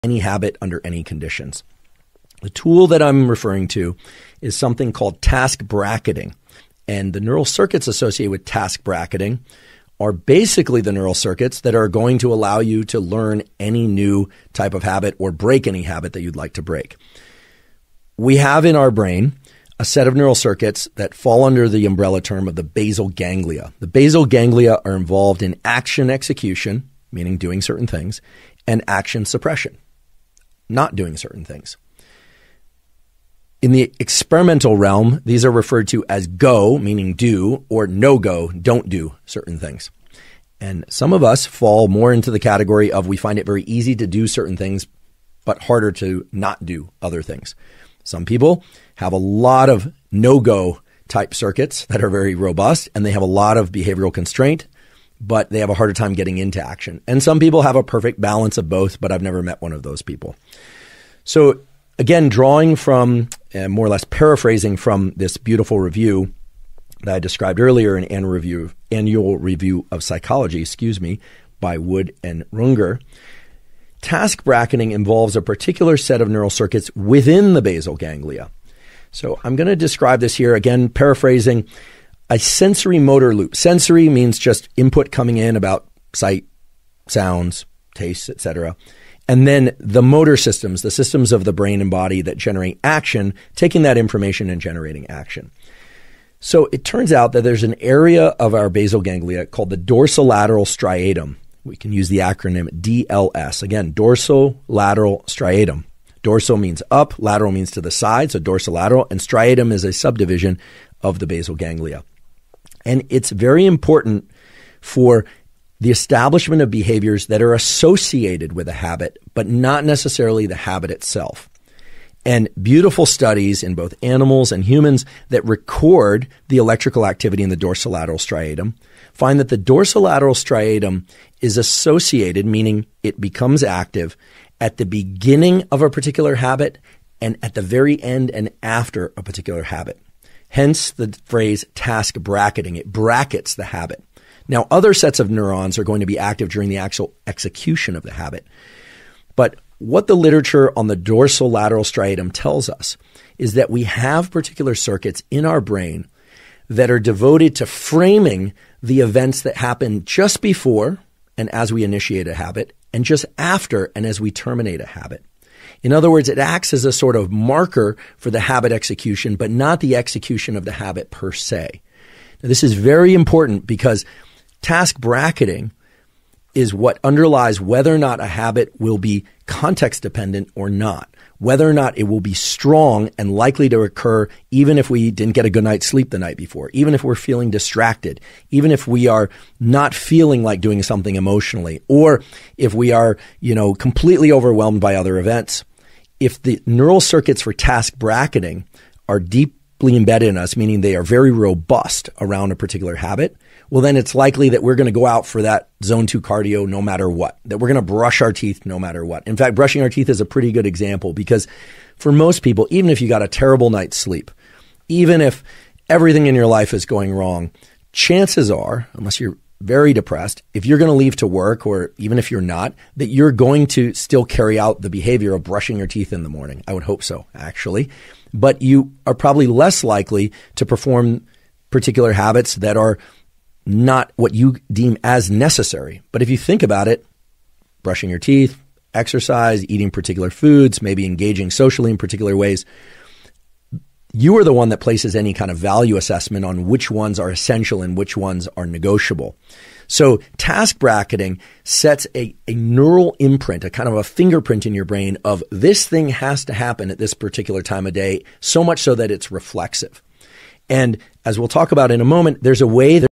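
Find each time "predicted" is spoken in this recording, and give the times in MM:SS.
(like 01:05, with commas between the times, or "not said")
not said.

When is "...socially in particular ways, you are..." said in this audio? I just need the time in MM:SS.
04:01.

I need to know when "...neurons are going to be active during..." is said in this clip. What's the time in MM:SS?
02:25.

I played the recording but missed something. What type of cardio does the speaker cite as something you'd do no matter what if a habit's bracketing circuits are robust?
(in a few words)
zone two cardio.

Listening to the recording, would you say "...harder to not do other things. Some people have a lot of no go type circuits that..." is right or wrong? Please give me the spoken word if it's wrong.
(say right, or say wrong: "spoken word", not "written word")
right.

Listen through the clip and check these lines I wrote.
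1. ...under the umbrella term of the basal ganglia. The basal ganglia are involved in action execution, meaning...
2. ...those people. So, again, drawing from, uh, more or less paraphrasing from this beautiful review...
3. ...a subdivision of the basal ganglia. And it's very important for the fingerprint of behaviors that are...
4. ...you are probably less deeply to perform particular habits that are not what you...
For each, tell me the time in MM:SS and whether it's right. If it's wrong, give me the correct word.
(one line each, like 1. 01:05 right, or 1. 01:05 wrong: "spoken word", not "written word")
1. 00:21 right
2. 00:59 right
3. 01:49 wrong: "establishment", not "fingerprint"
4. 03:48 wrong: "likely", not "deeply".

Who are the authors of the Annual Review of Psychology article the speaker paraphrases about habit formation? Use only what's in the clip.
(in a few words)
Wood and Runger.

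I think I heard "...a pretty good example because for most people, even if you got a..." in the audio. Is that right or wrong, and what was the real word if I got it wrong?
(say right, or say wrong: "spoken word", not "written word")
right.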